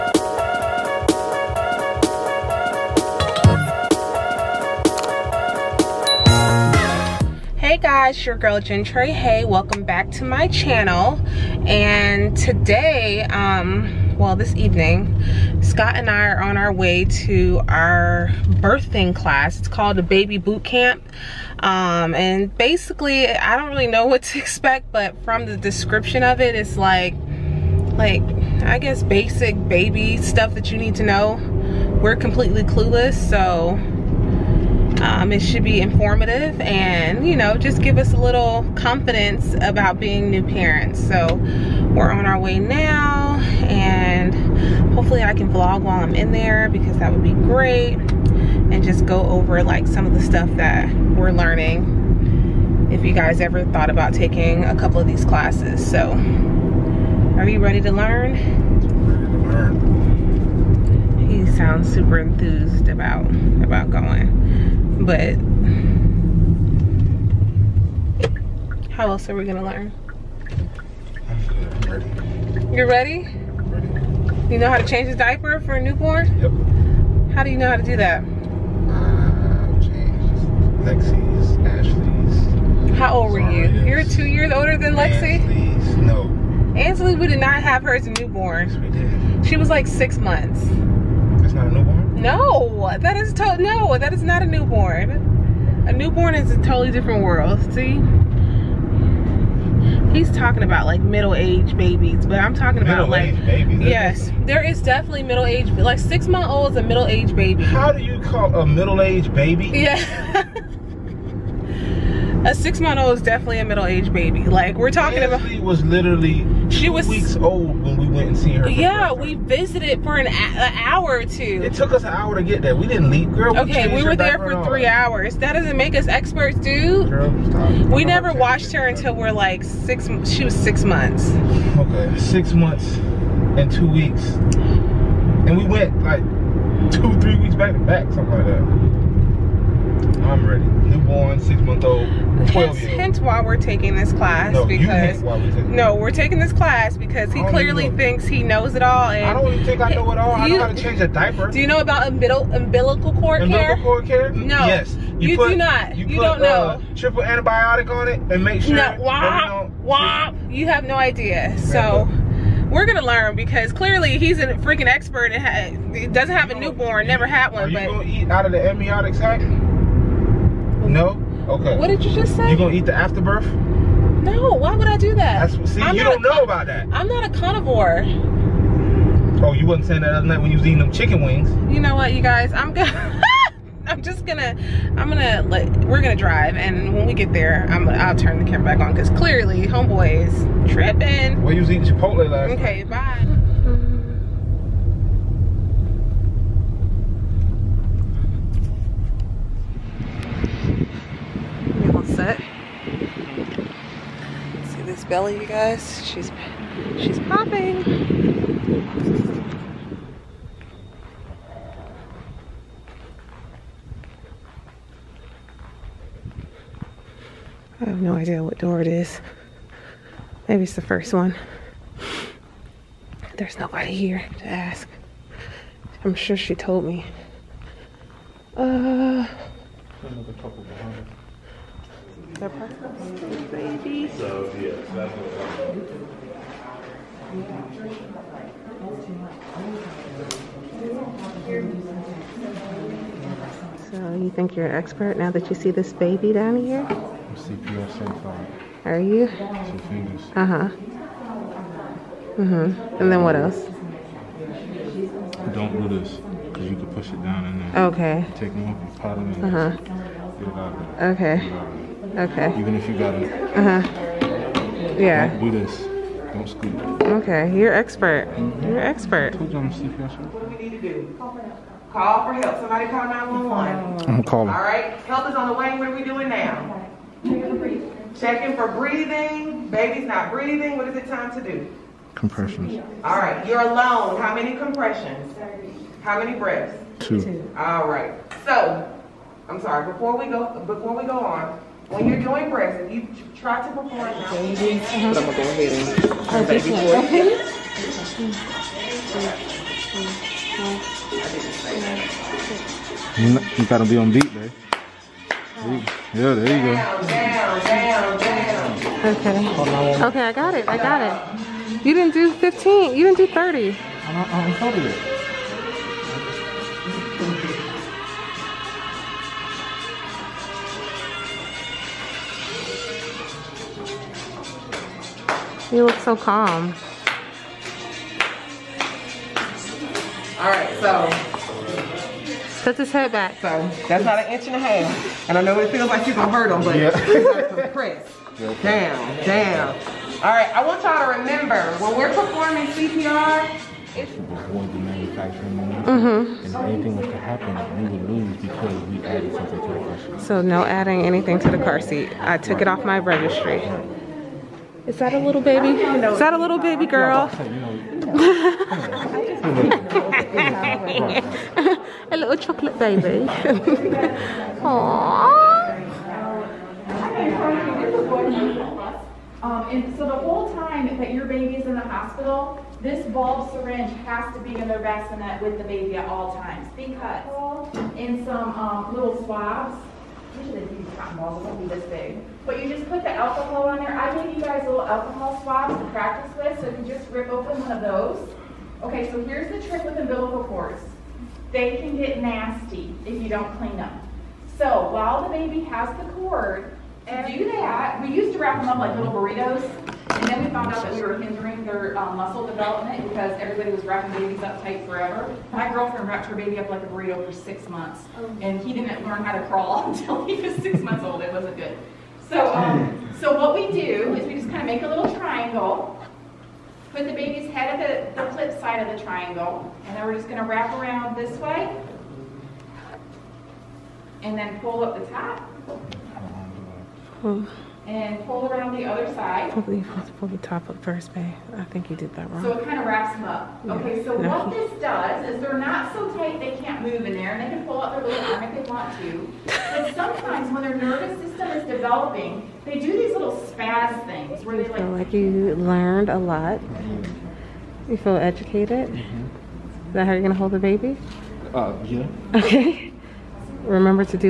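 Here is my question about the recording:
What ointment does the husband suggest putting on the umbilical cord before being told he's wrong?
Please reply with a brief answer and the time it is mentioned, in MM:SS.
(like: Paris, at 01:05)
triple antibiotic, at 02:36.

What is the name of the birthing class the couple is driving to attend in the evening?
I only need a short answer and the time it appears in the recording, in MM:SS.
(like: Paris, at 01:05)
Baby Boot Camp, at 00:20.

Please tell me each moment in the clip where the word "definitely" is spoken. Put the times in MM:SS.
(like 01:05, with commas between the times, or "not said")
01:44, 01:53.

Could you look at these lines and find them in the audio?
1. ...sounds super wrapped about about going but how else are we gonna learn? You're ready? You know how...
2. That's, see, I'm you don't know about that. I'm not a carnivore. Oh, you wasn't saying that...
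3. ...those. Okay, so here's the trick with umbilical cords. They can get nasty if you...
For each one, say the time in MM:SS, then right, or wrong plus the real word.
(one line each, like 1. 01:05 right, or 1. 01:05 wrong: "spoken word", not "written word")
1. 01:01 wrong: "enthused", not "wrapped"
2. 02:55 right
3. 06:27 right.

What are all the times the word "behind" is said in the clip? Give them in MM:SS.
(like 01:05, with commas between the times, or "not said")
03:50.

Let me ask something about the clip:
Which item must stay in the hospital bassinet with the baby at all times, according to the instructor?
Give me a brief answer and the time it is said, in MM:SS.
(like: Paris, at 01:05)
bulb syringe, at 06:13.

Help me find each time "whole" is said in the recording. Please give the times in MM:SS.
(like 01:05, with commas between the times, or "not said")
06:10.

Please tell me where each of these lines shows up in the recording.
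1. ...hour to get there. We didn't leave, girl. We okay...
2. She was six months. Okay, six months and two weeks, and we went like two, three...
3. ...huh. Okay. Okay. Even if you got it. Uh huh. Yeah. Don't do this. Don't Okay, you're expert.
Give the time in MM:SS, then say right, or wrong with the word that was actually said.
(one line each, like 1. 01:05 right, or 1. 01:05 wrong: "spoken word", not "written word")
1. 02:02 right
2. 02:10 right
3. 04:19 right.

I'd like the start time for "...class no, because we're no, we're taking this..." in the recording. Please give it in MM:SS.
02:24.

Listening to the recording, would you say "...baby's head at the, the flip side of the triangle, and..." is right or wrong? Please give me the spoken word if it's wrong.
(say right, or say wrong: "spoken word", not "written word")
right.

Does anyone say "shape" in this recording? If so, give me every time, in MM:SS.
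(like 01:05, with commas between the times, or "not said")
not said.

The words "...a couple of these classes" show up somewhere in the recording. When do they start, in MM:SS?
00:54.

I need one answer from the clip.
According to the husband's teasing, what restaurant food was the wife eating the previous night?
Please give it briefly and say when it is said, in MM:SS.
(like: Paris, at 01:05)
Chipotle, at 03:11.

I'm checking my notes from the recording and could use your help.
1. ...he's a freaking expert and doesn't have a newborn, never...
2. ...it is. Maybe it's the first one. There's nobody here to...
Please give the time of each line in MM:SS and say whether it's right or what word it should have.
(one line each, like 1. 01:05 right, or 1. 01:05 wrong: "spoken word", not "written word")
1. 02:44 right
2. 03:38 right.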